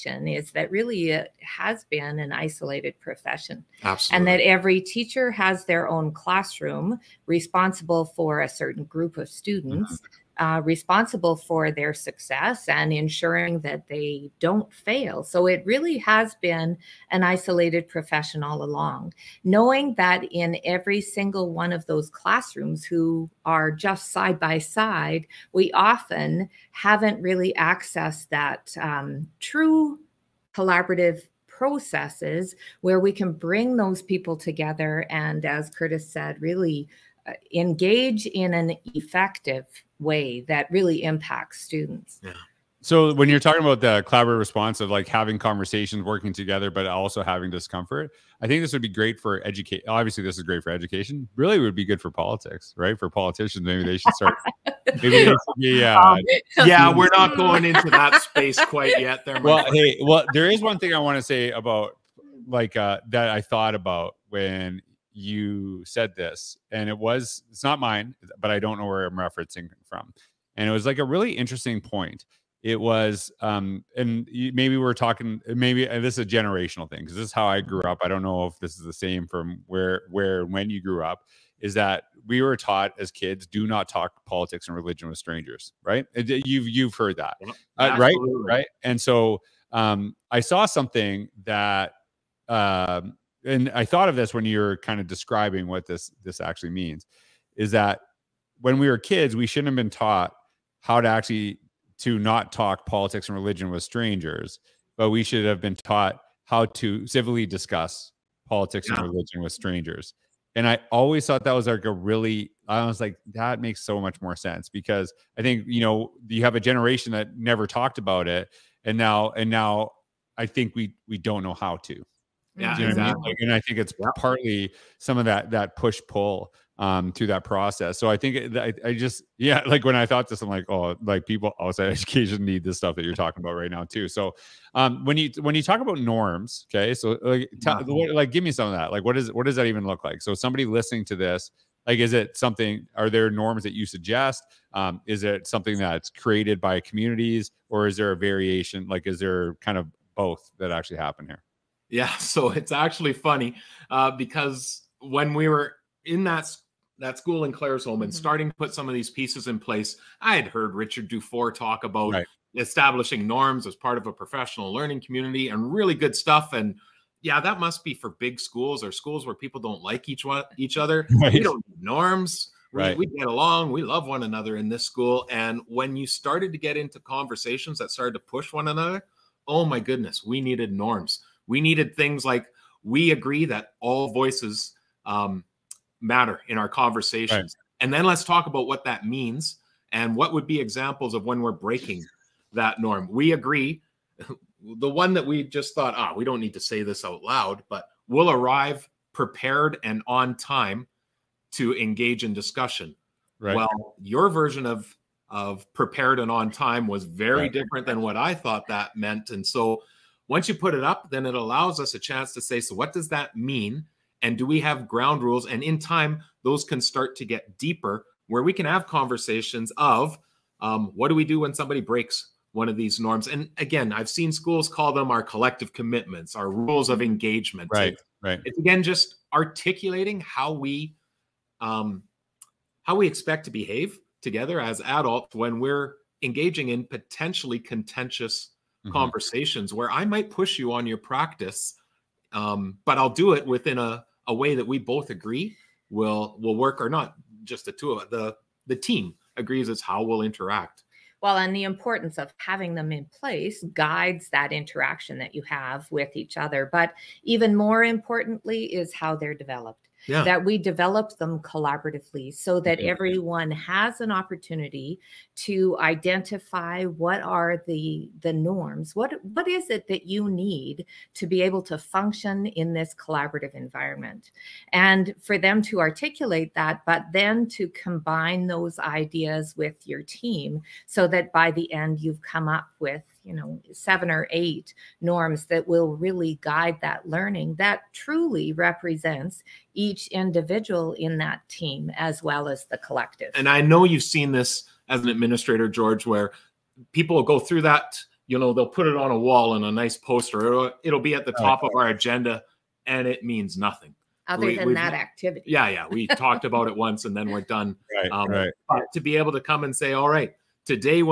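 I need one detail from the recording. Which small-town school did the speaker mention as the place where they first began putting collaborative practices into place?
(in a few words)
Claresholm.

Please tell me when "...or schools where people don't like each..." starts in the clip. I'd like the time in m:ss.
2:48.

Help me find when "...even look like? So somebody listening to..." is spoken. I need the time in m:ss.
2:19.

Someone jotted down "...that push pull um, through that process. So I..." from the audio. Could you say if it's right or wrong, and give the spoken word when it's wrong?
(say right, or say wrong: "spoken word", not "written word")
right.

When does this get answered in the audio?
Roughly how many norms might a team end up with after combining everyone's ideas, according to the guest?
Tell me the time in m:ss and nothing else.
4:43.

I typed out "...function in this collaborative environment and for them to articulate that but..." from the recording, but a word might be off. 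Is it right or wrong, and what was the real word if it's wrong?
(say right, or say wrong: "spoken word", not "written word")
right.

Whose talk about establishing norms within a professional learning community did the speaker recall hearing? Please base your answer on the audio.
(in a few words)
Richard DuFour.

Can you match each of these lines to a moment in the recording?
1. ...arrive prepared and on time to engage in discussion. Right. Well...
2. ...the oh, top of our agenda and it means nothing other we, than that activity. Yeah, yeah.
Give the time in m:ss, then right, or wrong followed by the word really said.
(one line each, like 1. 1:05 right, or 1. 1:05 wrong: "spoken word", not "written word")
1. 3:18 right
2. 5:01 right.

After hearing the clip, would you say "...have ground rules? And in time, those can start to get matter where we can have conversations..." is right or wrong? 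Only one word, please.
wrong.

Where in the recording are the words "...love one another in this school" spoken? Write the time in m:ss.
2:53.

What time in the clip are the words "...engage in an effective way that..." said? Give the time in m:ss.
0:37.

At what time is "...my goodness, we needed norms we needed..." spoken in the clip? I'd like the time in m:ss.
2:59.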